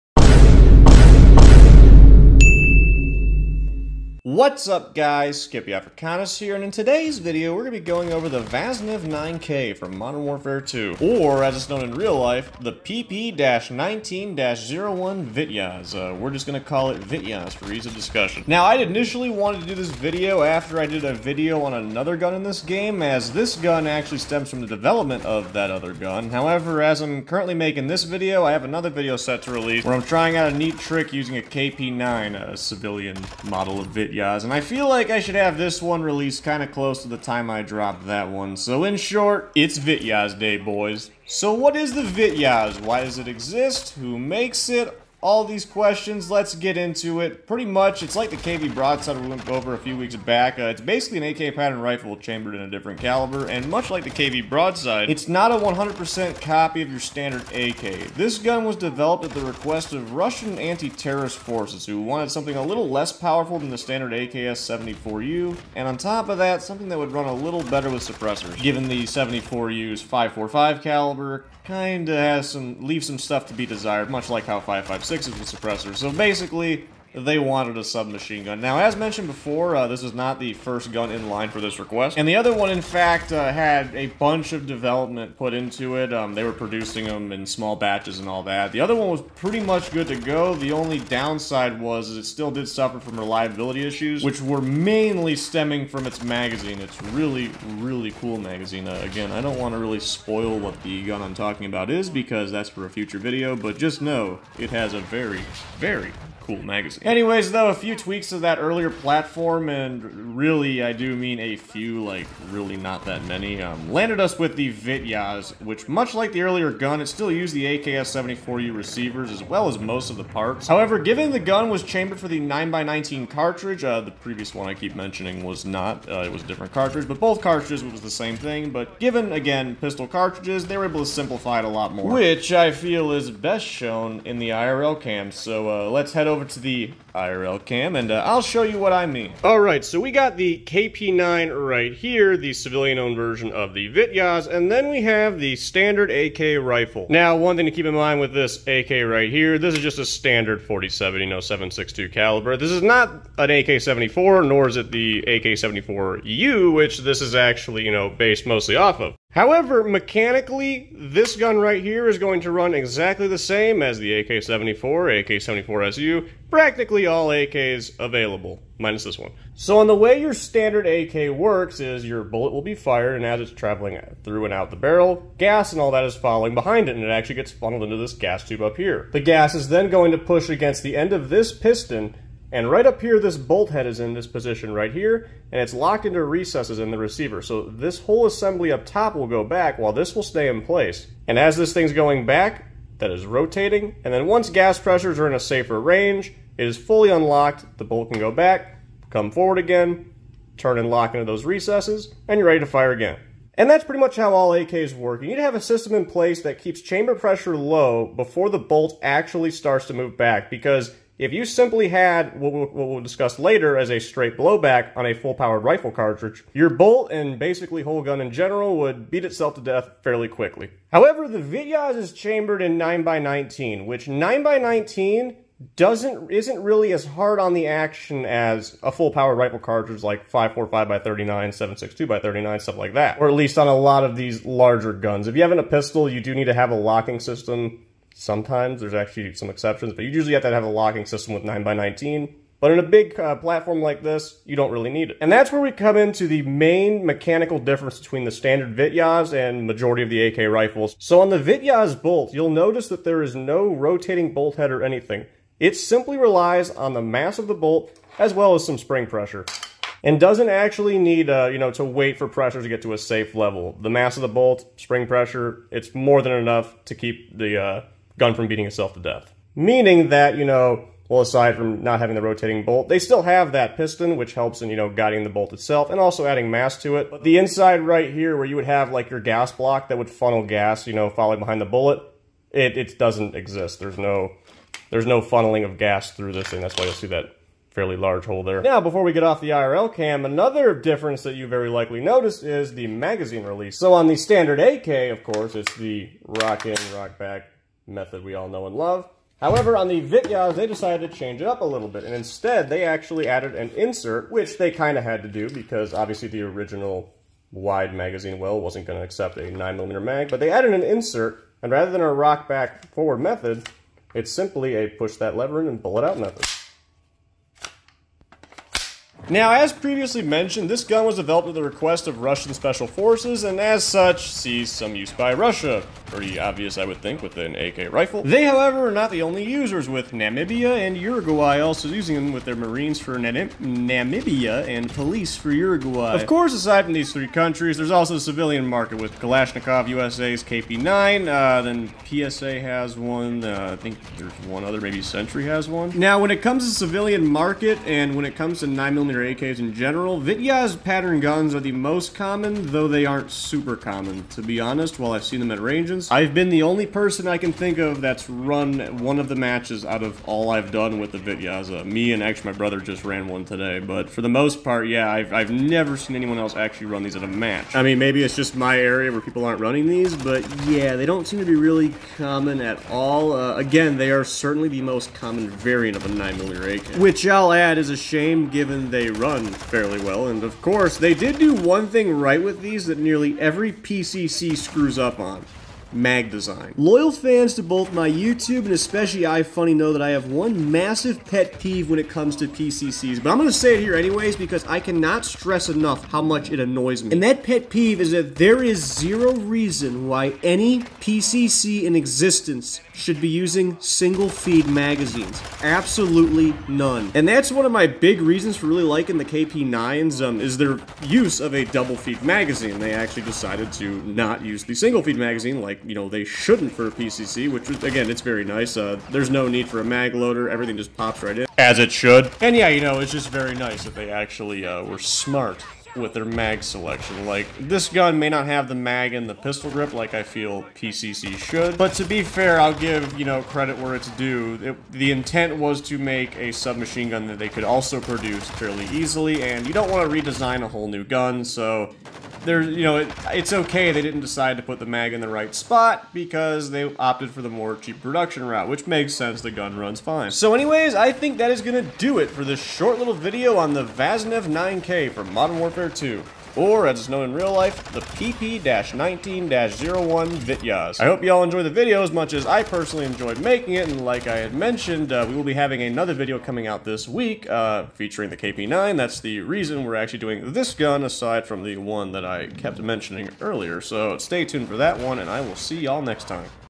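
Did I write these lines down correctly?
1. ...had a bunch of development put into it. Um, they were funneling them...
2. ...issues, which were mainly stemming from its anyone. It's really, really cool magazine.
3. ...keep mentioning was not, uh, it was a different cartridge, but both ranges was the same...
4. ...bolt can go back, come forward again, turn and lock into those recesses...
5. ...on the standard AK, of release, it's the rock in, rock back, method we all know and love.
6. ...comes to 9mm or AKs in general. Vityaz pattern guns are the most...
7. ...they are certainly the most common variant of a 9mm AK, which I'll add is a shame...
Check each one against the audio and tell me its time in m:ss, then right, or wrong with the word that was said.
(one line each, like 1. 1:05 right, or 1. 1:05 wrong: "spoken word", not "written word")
1. 1:23 wrong: "producing", not "funneling"
2. 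1:33 wrong: "magazine", not "anyone"
3. 2:04 wrong: "cartridges", not "ranges"
4. 3:17 right
5. 4:53 wrong: "course", not "release"
6. 5:48 right
7. 6:13 right.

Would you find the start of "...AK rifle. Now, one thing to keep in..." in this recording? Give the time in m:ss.
2:26.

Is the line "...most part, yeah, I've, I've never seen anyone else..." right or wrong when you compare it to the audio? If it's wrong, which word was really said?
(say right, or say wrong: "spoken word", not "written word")
right.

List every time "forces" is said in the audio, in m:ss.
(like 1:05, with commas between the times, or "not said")
1:01, 5:22.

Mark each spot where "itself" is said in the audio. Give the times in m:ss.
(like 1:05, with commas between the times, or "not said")
3:39, 4:28, 4:35.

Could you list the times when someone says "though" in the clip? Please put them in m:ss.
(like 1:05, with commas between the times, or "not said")
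1:47, 5:52.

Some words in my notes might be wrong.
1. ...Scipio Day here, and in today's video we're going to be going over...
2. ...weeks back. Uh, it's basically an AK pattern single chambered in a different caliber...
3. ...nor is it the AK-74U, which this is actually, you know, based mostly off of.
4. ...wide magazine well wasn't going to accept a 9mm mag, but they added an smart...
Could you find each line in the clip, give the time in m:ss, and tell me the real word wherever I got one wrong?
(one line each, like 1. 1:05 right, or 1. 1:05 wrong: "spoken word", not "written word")
1. 0:05 wrong: "Africanus", not "Day"
2. 0:49 wrong: "rifle", not "single"
3. 2:34 right
4. 5:07 wrong: "insert", not "smart".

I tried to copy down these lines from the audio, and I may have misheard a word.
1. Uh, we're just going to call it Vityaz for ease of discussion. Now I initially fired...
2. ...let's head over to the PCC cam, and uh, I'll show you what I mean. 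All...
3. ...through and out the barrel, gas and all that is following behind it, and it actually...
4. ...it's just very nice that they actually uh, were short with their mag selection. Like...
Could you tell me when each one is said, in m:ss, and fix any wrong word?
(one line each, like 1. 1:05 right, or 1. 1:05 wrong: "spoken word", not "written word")
1. 0:15 wrong: "wanted", not "fired"
2. 2:15 wrong: "IRL", not "PCC"
3. 2:54 right
4. 7:02 wrong: "smart", not "short".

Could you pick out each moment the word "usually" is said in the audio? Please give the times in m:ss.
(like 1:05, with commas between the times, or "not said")
4:00.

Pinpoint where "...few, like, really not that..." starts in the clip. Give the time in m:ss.
1:51.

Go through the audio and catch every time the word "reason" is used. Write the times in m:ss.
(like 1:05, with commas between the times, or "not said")
6:39, 6:48, 7:49.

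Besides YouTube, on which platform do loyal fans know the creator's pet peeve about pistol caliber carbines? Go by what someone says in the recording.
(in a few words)
iFunny.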